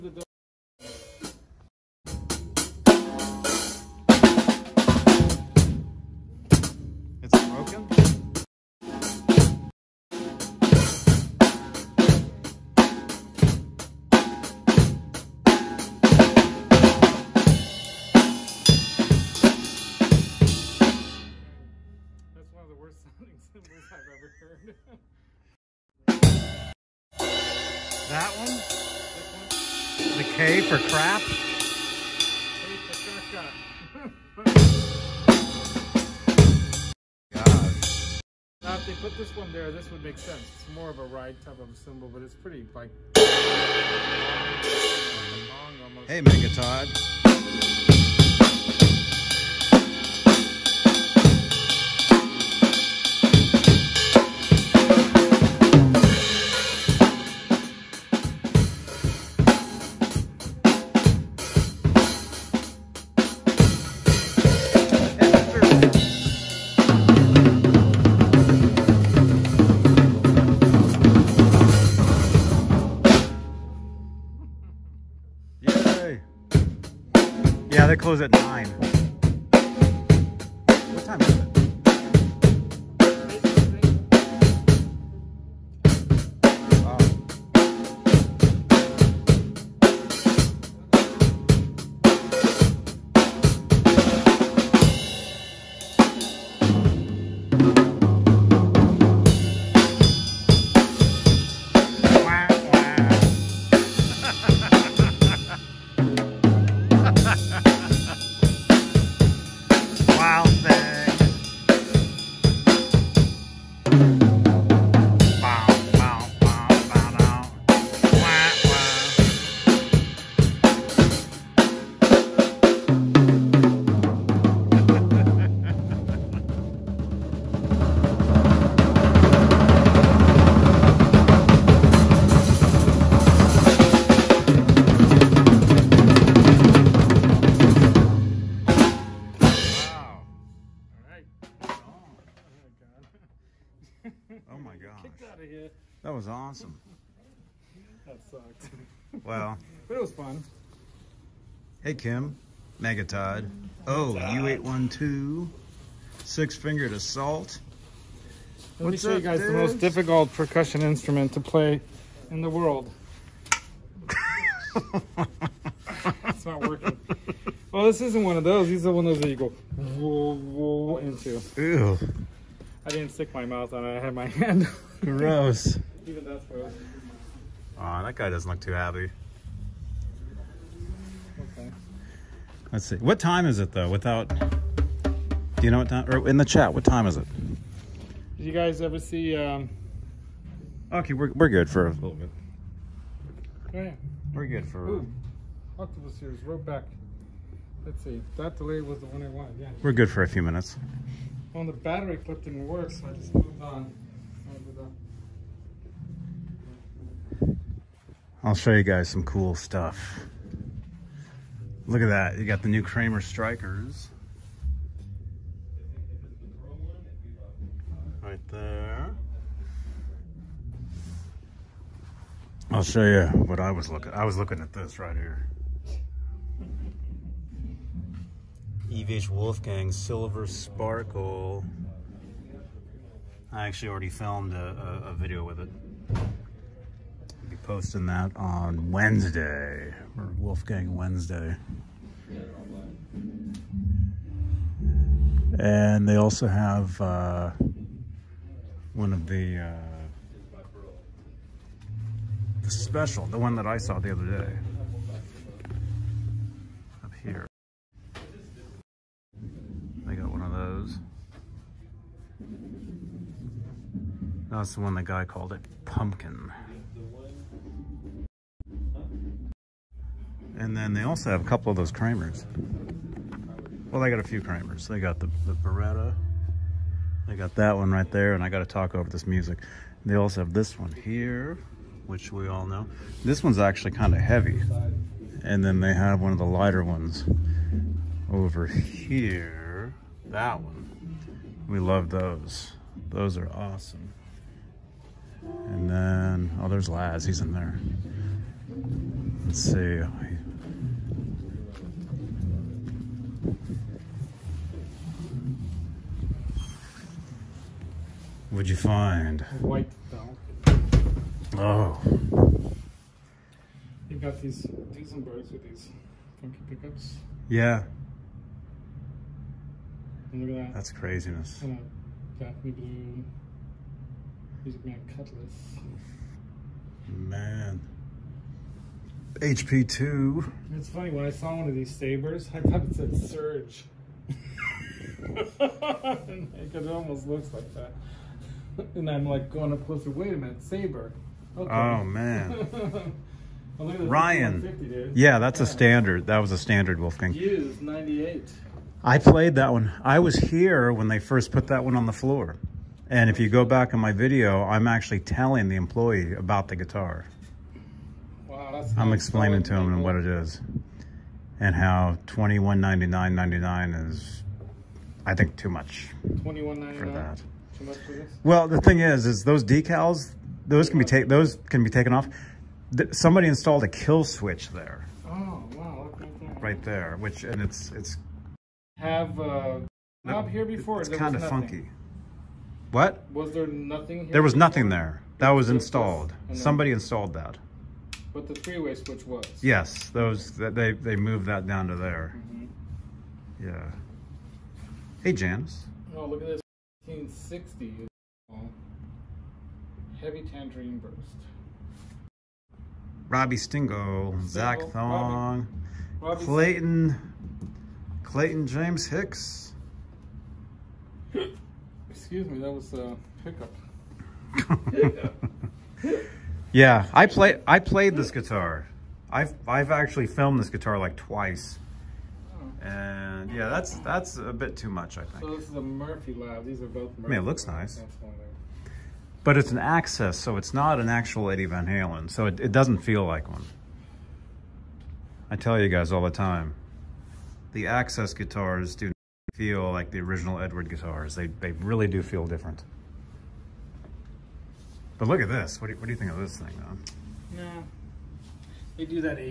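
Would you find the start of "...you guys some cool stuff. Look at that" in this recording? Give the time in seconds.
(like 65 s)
208 s.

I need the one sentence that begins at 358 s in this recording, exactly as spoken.
Wow, I'm explaining to him what it is and how 21.99.99 is I think too much for that this?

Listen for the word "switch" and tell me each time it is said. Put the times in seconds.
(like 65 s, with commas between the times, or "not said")
374 s, 388 s.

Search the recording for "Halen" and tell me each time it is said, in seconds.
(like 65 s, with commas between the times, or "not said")
431 s.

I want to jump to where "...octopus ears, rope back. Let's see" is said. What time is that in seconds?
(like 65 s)
195 s.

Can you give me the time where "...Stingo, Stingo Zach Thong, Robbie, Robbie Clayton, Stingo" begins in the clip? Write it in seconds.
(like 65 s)
403 s.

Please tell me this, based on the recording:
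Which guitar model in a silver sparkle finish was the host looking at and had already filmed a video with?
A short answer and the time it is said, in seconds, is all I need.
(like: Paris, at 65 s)
EVH Wolfgang, at 228 s.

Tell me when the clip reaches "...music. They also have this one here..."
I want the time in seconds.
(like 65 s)
279 s.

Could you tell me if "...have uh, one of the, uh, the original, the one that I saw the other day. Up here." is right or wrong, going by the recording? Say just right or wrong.
wrong.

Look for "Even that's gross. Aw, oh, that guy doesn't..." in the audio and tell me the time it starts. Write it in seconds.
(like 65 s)
176 s.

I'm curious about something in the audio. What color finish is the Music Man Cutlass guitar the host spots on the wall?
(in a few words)
Daphne Blue.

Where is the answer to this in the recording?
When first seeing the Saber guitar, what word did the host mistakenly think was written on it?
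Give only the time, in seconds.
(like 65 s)
333 s.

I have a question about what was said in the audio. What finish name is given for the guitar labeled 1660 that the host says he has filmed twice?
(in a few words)
Heavy Tangerine Burst.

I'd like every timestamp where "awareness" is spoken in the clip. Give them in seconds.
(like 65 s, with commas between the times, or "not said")
not said.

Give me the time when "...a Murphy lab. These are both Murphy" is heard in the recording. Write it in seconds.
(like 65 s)
425 s.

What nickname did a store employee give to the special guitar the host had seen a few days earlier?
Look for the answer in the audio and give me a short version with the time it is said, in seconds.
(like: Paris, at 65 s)
Pumpkin, at 265 s.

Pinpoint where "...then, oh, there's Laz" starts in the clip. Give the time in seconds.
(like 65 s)
295 s.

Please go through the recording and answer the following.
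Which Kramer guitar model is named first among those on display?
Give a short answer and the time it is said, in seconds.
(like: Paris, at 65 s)
Beretta, at 275 s.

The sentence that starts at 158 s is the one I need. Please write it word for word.
Let What's me show up, you guys dudes?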